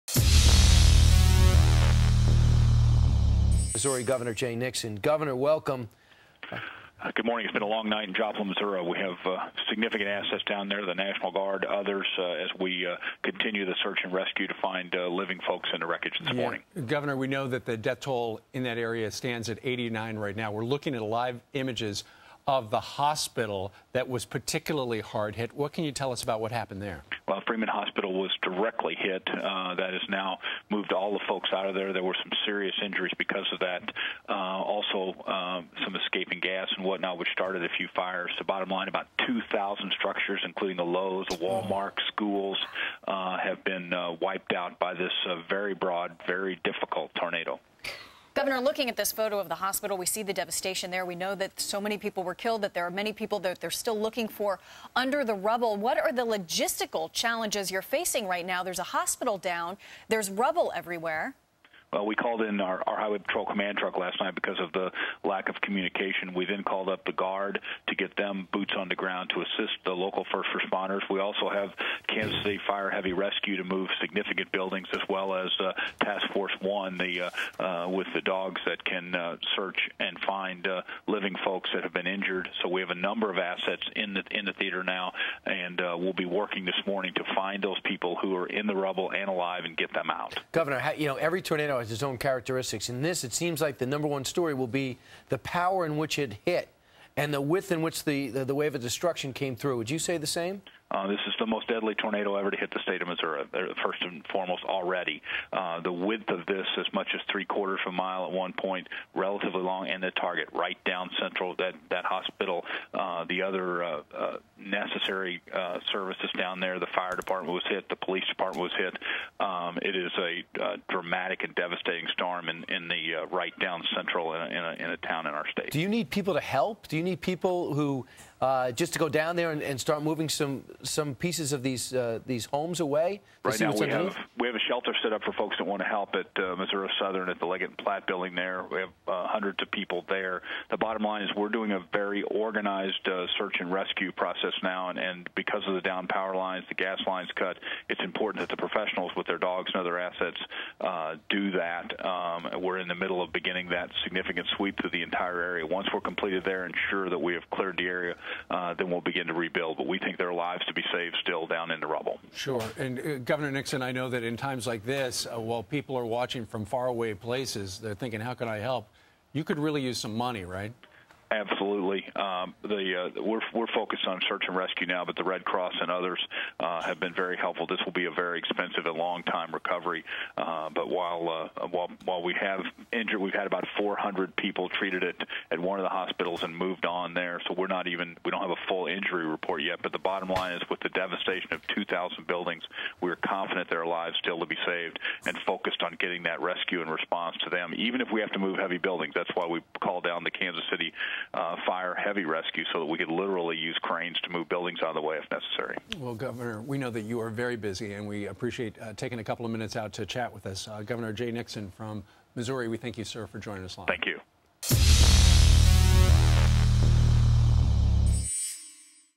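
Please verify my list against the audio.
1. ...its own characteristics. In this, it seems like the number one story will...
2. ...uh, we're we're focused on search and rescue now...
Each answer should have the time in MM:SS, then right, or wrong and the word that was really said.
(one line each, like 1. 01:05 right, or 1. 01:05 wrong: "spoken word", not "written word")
1. 01:31 right
2. 02:53 right.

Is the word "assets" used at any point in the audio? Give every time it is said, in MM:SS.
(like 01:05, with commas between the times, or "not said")
00:10, 01:23, 02:29.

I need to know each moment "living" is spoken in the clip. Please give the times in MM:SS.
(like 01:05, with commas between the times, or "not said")
00:15, 01:21.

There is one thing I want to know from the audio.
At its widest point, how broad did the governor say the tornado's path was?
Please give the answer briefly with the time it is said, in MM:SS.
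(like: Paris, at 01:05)
three quarters of a mile, at 01:47.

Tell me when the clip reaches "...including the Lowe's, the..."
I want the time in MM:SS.
00:40.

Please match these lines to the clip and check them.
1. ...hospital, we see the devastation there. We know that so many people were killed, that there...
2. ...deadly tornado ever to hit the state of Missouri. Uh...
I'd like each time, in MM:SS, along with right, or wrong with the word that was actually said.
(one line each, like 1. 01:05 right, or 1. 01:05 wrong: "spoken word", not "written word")
1. 00:49 right
2. 01:41 right.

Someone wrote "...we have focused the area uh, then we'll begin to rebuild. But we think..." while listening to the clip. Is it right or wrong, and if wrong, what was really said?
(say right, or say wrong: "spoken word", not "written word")
wrong: "cleared", not "focused".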